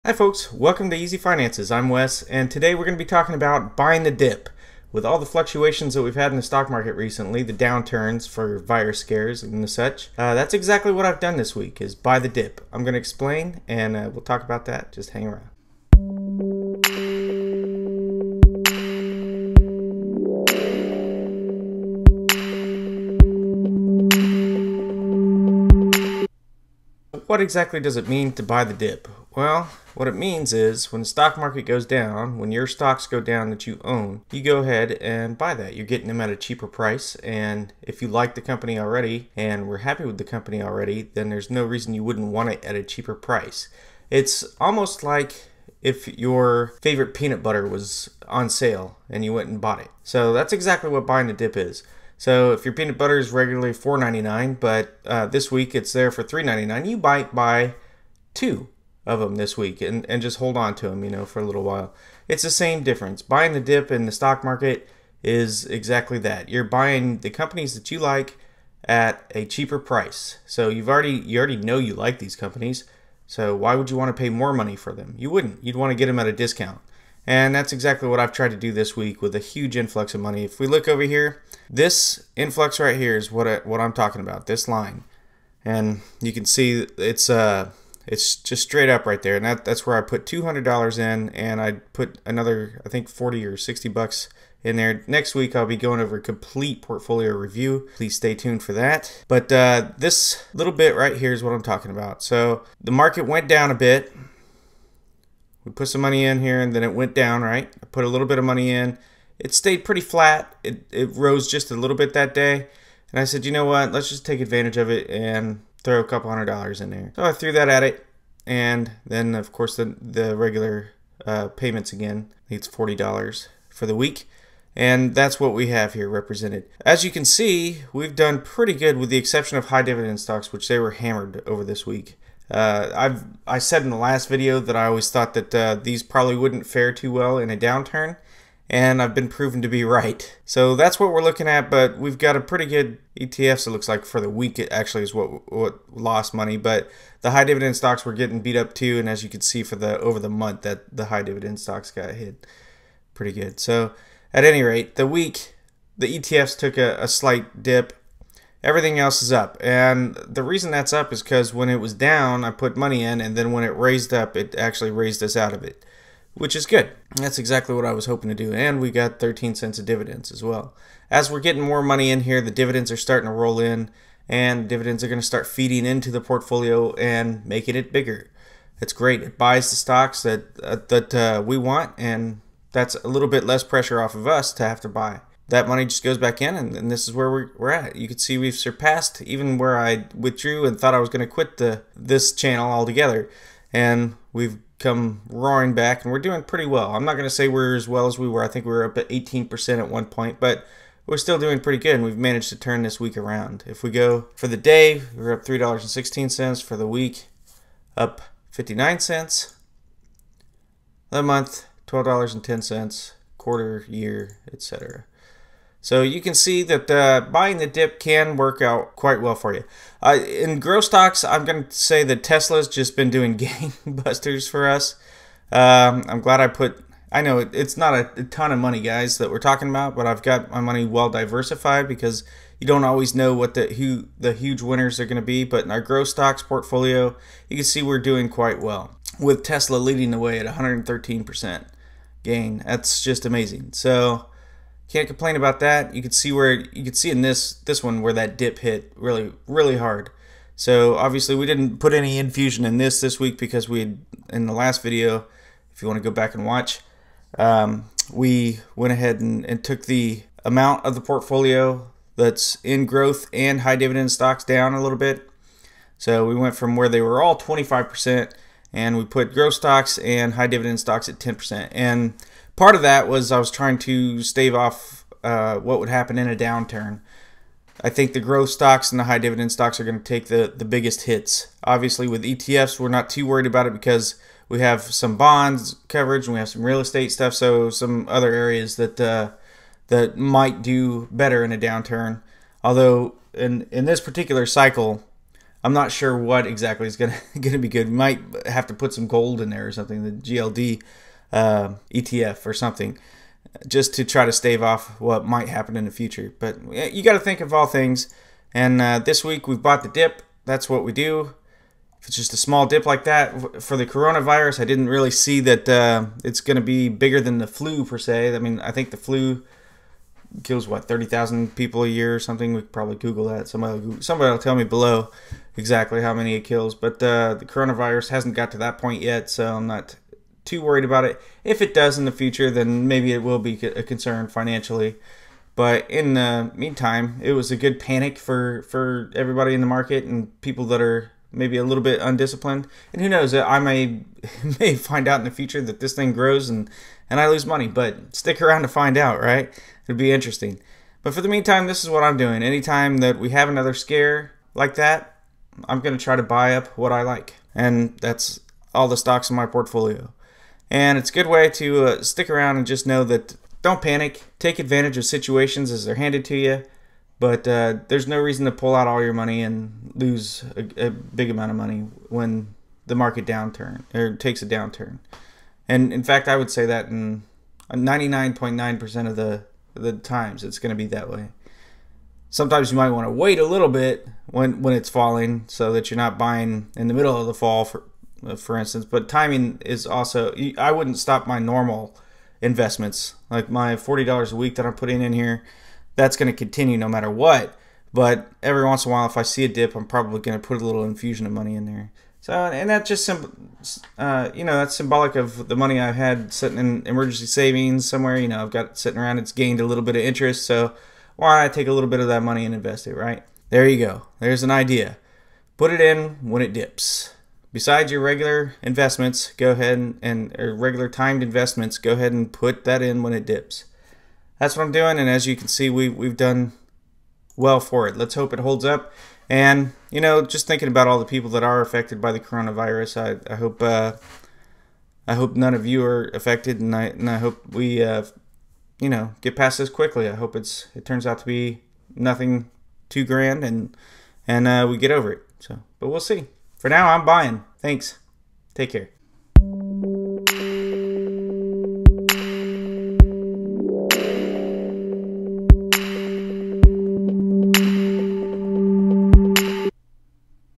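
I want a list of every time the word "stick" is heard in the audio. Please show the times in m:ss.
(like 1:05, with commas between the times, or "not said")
5:48, 6:02.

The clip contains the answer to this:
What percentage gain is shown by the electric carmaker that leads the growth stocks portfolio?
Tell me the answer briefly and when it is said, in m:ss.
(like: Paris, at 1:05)
113%, at 4:00.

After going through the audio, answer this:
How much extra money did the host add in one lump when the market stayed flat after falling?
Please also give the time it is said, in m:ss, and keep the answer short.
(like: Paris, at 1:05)
$200, at 1:30.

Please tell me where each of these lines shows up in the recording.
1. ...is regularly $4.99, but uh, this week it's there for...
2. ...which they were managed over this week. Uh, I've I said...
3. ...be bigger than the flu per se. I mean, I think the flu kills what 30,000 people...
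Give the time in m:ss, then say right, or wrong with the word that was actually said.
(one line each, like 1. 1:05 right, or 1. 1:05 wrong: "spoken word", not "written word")
1. 0:53 right
2. 2:10 wrong: "hammered", not "managed"
3. 5:16 right.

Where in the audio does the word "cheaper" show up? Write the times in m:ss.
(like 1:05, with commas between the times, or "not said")
0:36, 0:42, 1:09.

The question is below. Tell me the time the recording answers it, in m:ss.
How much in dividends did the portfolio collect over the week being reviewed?
2:49.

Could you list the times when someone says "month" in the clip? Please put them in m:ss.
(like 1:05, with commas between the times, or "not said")
2:30, 3:31.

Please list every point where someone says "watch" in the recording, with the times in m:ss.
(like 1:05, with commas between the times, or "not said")
4:16.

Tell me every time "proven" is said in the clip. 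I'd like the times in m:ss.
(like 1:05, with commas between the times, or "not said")
2:19.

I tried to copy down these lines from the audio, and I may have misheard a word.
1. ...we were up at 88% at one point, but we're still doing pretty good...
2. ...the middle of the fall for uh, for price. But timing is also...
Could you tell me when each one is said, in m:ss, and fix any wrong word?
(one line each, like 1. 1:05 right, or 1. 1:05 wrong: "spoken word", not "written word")
1. 3:18 wrong: "18", not "88"
2. 6:26 wrong: "instance", not "price".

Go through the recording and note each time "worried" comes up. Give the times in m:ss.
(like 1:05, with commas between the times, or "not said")
4:43, 5:30.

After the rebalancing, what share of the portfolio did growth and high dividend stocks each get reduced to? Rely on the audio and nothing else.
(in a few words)
10%.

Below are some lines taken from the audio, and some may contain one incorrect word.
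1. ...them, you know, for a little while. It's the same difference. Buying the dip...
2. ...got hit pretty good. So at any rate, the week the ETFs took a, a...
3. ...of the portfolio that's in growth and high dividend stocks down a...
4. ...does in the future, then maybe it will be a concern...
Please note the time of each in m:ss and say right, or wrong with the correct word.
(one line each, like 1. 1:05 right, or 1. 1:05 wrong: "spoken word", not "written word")
1. 1:00 right
2. 2:31 right
3. 4:20 right
4. 5:31 right.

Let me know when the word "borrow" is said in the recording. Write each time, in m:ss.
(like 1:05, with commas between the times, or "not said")
not said.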